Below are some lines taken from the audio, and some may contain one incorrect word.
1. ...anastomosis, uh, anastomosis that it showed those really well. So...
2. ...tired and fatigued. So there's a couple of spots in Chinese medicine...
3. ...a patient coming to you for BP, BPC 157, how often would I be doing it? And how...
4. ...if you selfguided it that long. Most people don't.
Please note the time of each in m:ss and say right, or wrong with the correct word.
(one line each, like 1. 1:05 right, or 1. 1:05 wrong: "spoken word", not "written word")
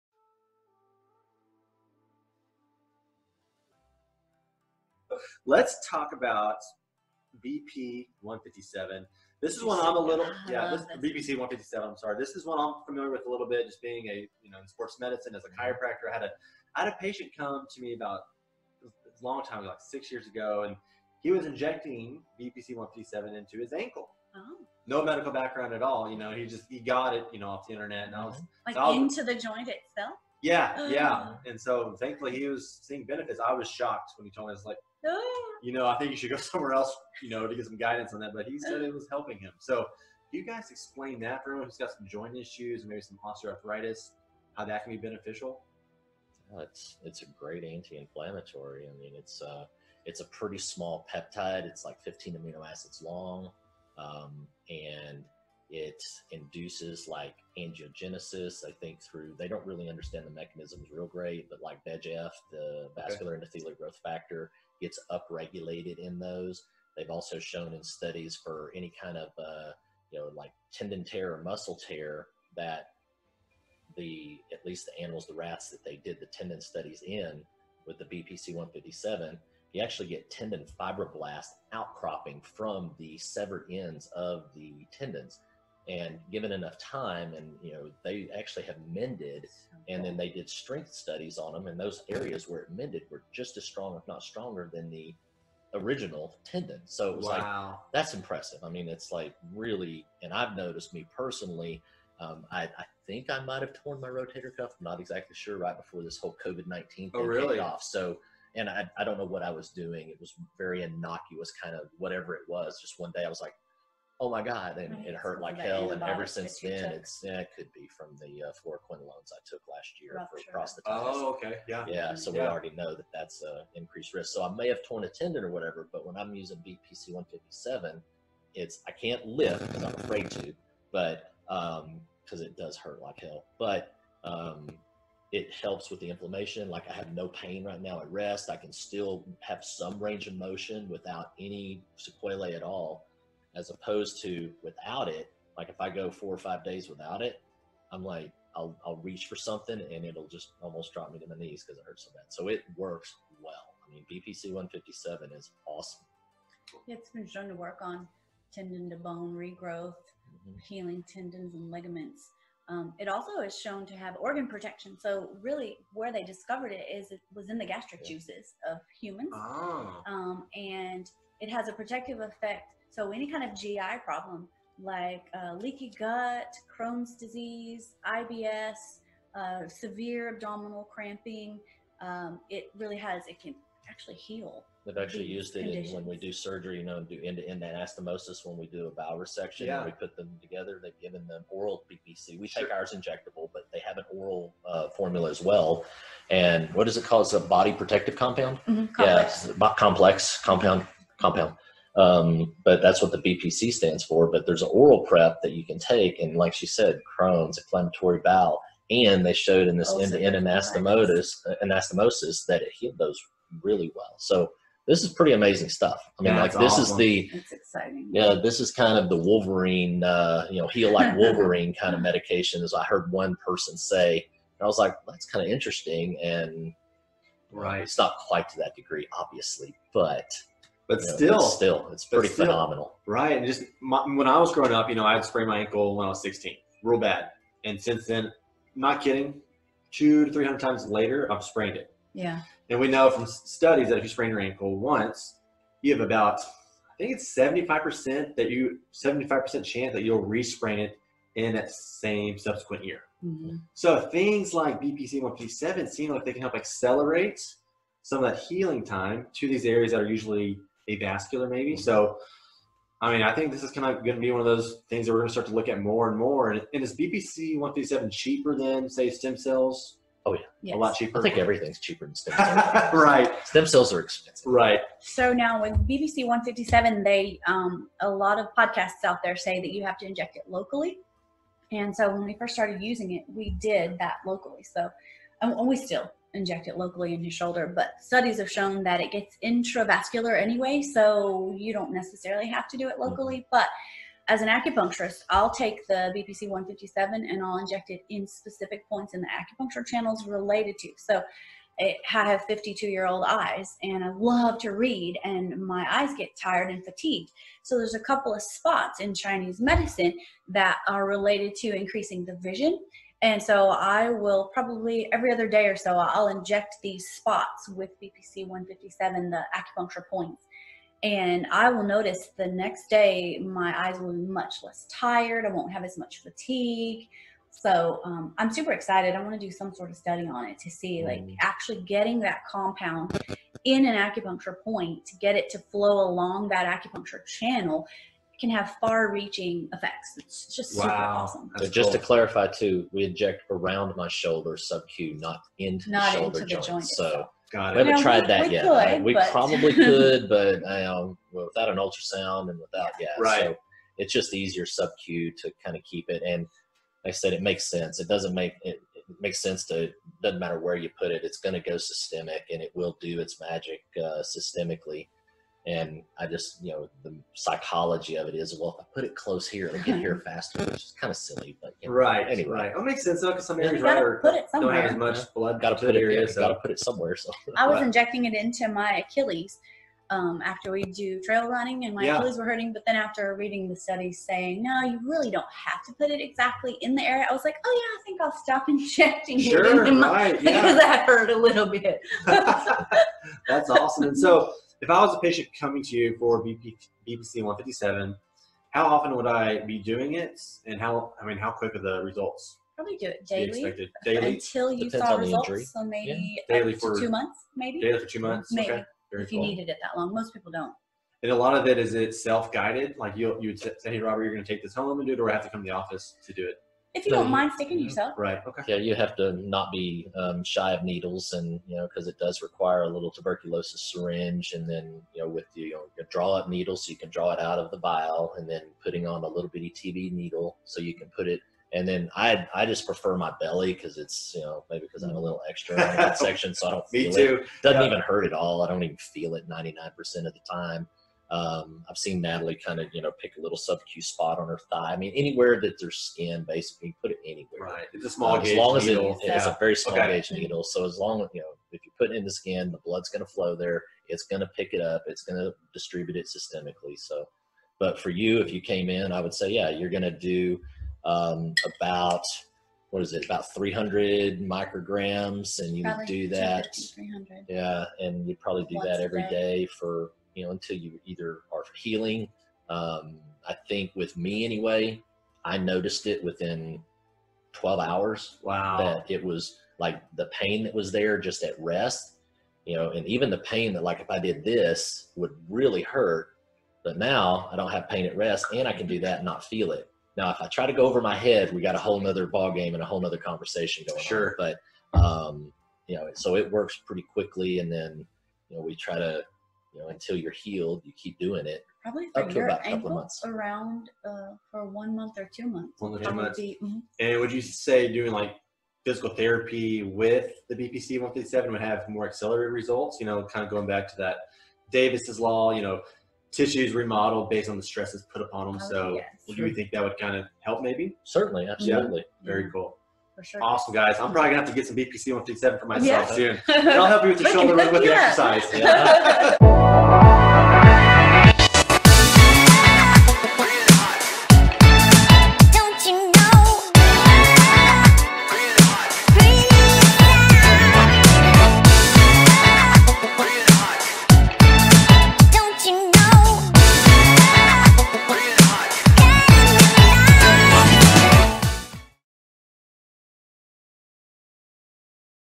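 1. 3:30 wrong: "healed", not "showed"
2. 5:06 right
3. 6:35 right
4. 6:49 wrong: "needed", not "selfguided".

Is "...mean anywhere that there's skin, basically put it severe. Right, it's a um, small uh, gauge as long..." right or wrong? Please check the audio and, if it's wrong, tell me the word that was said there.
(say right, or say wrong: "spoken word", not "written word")
wrong: "anywhere", not "severe".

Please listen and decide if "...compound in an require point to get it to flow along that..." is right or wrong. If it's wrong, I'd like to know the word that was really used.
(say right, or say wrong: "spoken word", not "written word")
wrong: "acupuncture", not "require".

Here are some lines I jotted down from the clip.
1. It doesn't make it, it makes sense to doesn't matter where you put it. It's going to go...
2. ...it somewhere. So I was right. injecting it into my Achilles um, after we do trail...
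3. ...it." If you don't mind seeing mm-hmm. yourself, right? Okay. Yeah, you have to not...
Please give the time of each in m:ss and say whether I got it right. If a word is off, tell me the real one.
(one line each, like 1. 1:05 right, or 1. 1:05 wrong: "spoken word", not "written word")
1. 5:57 right
2. 6:16 right
3. 6:56 wrong: "sticking", not "seeing".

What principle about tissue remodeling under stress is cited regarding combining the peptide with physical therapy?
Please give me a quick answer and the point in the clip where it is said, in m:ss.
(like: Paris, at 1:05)
Davis's law, at 8:34.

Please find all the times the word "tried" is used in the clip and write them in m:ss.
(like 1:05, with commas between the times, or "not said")
5:48.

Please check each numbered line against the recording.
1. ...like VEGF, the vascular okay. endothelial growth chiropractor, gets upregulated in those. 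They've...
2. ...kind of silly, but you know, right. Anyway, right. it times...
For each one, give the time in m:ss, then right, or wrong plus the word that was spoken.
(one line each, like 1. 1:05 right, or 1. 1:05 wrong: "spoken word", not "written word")
1. 1:01 wrong: "factor", not "chiropractor"
2. 6:10 wrong: "makes", not "times".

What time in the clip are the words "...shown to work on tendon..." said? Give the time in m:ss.
2:37.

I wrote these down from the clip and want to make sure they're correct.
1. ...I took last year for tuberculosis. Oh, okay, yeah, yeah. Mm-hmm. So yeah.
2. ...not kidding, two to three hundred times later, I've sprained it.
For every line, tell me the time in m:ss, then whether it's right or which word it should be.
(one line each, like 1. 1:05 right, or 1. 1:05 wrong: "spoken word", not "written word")
1. 1:59 wrong: "prostatitis", not "tuberculosis"
2. 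3:58 right.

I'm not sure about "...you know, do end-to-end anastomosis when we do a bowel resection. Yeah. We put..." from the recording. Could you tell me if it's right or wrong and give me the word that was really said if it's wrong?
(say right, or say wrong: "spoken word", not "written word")
right.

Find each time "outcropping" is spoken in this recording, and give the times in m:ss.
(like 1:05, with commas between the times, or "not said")
1:21.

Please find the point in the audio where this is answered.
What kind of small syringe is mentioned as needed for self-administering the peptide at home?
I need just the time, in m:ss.
7:03.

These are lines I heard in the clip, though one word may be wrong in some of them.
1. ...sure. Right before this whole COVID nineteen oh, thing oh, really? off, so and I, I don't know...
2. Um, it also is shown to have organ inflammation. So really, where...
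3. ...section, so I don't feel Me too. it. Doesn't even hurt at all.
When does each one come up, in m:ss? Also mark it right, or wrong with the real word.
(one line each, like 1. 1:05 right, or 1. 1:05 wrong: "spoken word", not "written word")
1. 1:45 right
2. 2:42 wrong: "protection", not "inflammation"
3. 7:16 right.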